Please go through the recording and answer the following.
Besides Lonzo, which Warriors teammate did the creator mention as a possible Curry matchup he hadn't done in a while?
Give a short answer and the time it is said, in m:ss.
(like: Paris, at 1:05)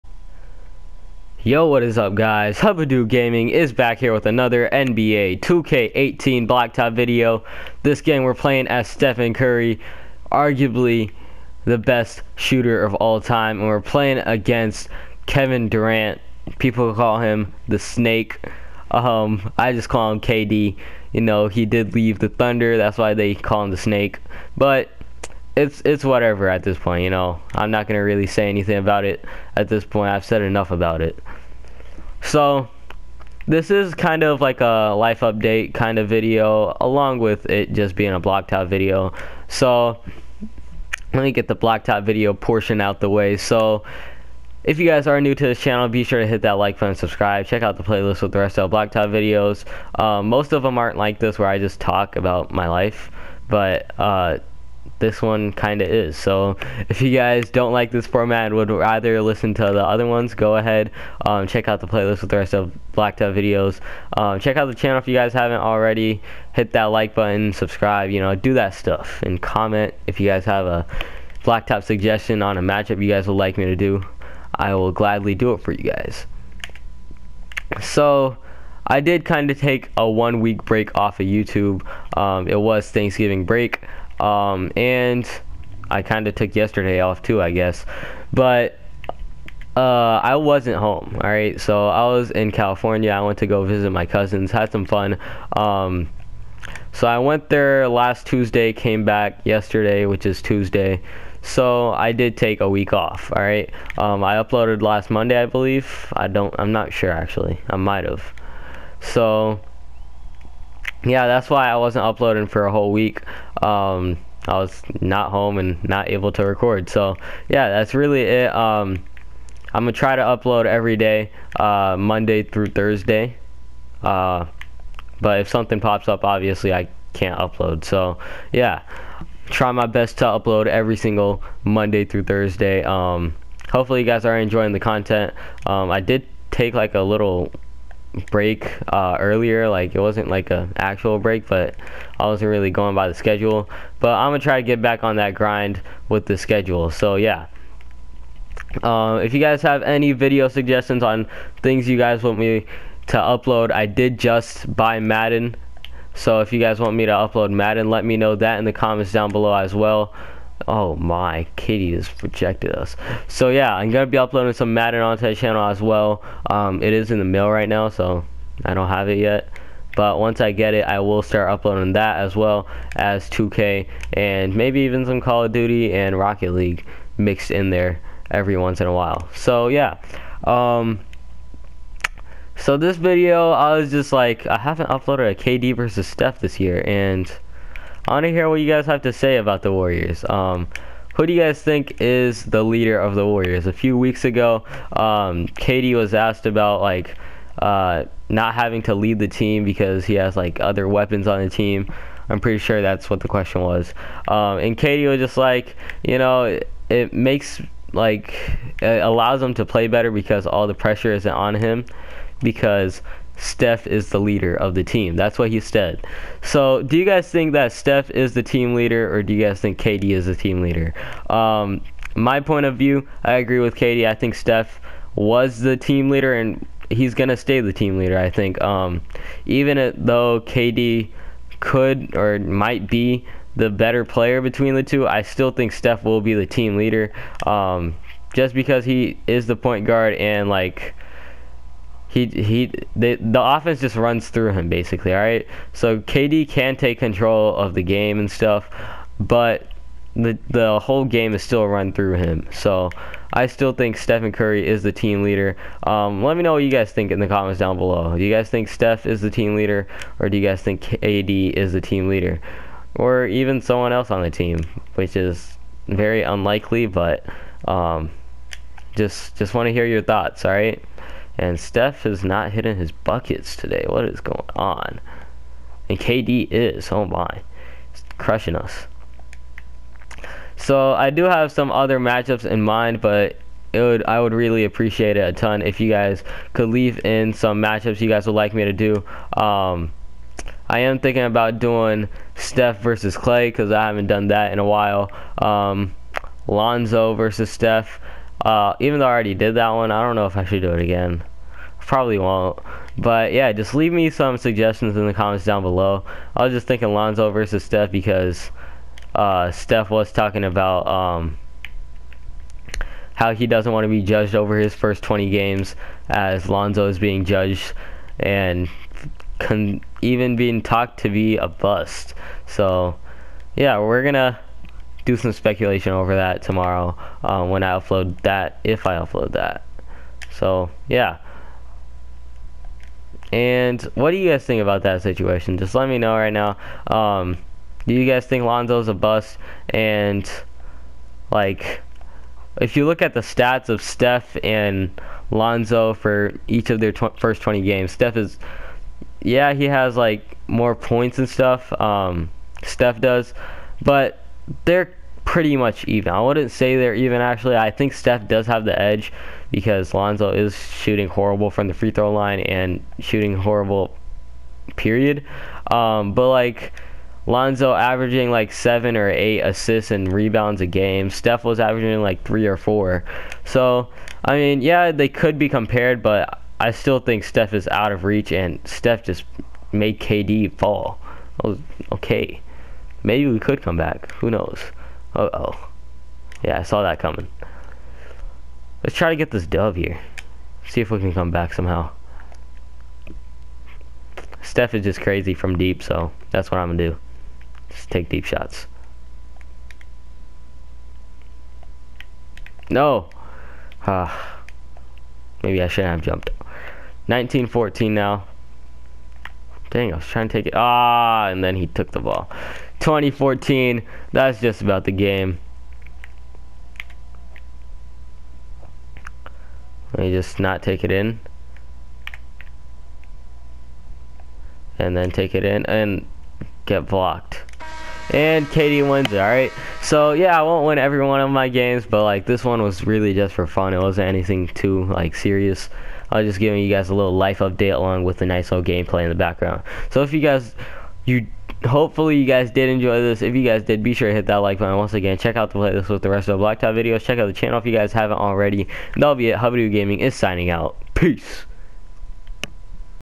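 Clay, at 4:53.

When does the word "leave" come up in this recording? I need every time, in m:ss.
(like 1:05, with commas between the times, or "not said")
0:21, 4:46, 5:03.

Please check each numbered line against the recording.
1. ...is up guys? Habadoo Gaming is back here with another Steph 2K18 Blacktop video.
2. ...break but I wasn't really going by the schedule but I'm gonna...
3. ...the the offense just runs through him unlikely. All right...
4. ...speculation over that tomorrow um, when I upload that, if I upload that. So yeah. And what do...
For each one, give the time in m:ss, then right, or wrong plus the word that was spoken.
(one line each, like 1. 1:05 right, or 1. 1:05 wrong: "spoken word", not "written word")
1. 0:01 wrong: "NBA", not "Steph"
2. 2:21 right
3. 4:02 wrong: "basically", not "unlikely"
4. 5:25 right.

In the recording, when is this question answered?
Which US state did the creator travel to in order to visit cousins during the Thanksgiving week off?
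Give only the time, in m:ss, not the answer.
1:32.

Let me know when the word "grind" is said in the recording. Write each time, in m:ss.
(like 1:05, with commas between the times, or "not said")
2:25.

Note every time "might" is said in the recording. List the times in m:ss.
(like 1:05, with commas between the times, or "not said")
1:47, 3:52.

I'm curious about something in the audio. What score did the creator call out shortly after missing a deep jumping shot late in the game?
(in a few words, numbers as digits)
19-14.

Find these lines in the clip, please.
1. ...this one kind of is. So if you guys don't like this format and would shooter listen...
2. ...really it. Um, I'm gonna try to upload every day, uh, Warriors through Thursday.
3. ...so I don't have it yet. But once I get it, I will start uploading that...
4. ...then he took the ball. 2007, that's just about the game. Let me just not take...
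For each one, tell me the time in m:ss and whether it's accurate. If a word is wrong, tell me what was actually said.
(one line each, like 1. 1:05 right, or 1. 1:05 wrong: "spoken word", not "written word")
1. 0:54 wrong: "rather", not "shooter"
2. 1:57 wrong: "Monday", not "Warriors"
3. 2:47 right
4. 6:51 wrong: "2014", not "2007".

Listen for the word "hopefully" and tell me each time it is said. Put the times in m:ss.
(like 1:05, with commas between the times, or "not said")
2:13, 7:21.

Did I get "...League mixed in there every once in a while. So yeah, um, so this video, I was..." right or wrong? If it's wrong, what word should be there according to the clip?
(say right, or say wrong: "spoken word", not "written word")
right.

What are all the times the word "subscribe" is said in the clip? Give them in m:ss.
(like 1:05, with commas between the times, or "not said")
0:46, 1:07.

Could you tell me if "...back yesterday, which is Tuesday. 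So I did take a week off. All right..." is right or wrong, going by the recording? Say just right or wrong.
right.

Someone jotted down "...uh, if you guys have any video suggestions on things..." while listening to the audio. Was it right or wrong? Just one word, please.
right.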